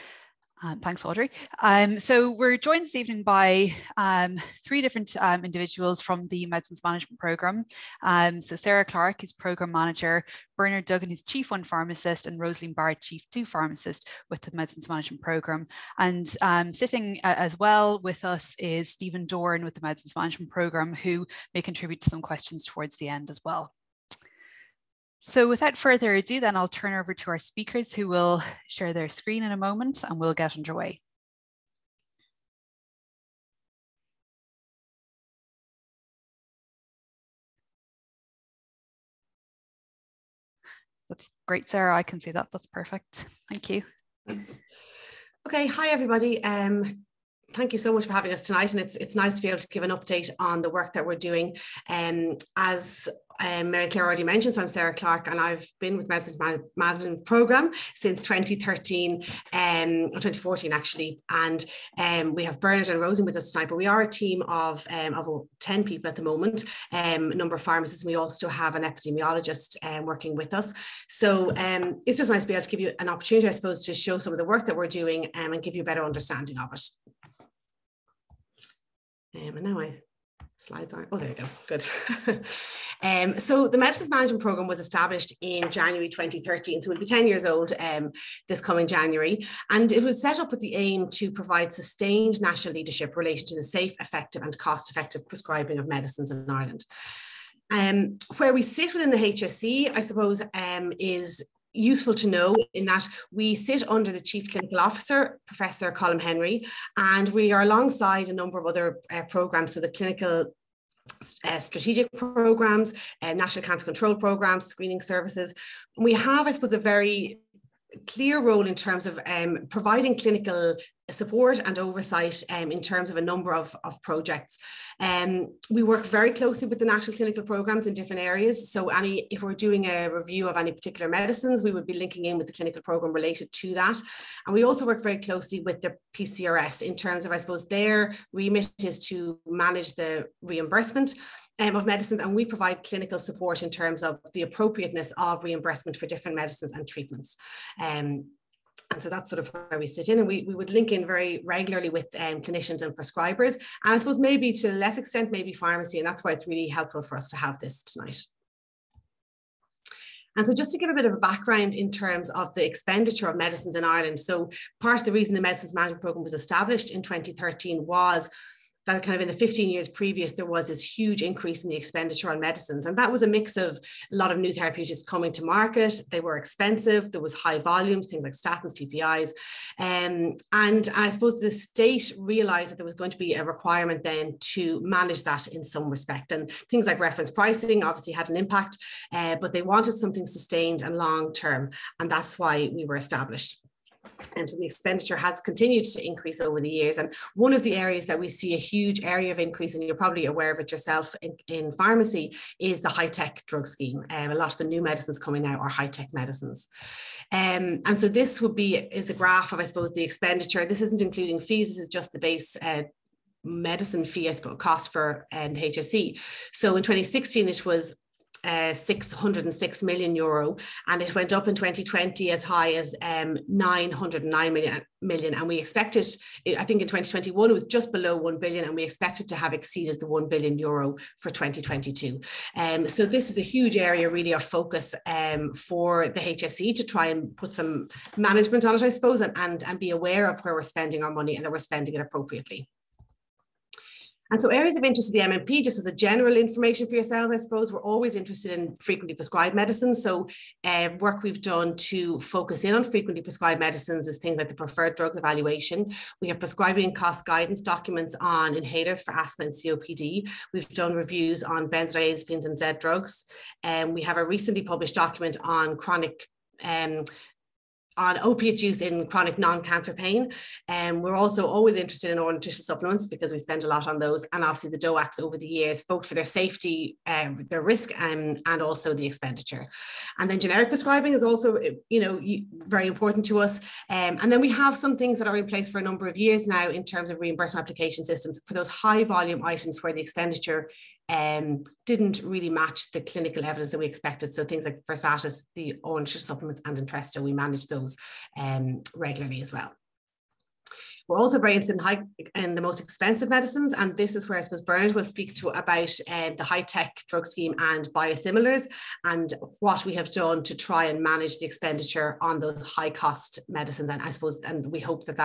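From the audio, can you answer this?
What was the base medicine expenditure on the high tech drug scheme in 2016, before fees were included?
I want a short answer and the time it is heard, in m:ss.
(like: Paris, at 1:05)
606 million euro, at 3:38.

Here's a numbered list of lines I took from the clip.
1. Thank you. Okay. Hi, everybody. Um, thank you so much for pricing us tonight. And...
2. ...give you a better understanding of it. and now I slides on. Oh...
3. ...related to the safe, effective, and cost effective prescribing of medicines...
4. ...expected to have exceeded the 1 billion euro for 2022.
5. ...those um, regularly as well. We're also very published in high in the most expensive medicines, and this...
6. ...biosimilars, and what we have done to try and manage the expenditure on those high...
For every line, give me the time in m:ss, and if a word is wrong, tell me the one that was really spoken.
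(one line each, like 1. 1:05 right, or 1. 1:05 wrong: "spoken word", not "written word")
1. 0:43 wrong: "having", not "pricing"
2. 1:15 right
3. 1:33 right
4. 3:48 right
5. 4:57 wrong: "interested", not "published"
6. 5:07 right.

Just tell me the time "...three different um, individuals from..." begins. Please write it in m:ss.
0:04.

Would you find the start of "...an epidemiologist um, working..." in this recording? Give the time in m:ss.
1:08.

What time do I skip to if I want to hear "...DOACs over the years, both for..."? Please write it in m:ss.
4:34.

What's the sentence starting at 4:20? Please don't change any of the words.
We've done reviews on benzodiazepines and Z drugs.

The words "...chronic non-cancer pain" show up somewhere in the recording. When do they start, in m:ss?
4:29.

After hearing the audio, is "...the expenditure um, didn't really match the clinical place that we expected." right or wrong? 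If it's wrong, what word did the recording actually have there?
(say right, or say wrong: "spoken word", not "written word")
wrong: "evidence", not "place".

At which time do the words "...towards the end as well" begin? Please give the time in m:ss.
0:22.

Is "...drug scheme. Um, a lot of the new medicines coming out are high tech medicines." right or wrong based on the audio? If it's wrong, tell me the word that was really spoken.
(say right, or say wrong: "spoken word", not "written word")
right.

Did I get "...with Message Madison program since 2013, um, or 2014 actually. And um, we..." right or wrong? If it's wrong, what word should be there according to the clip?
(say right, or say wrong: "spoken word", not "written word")
right.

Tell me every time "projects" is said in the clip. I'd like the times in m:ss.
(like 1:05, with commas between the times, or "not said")
2:04.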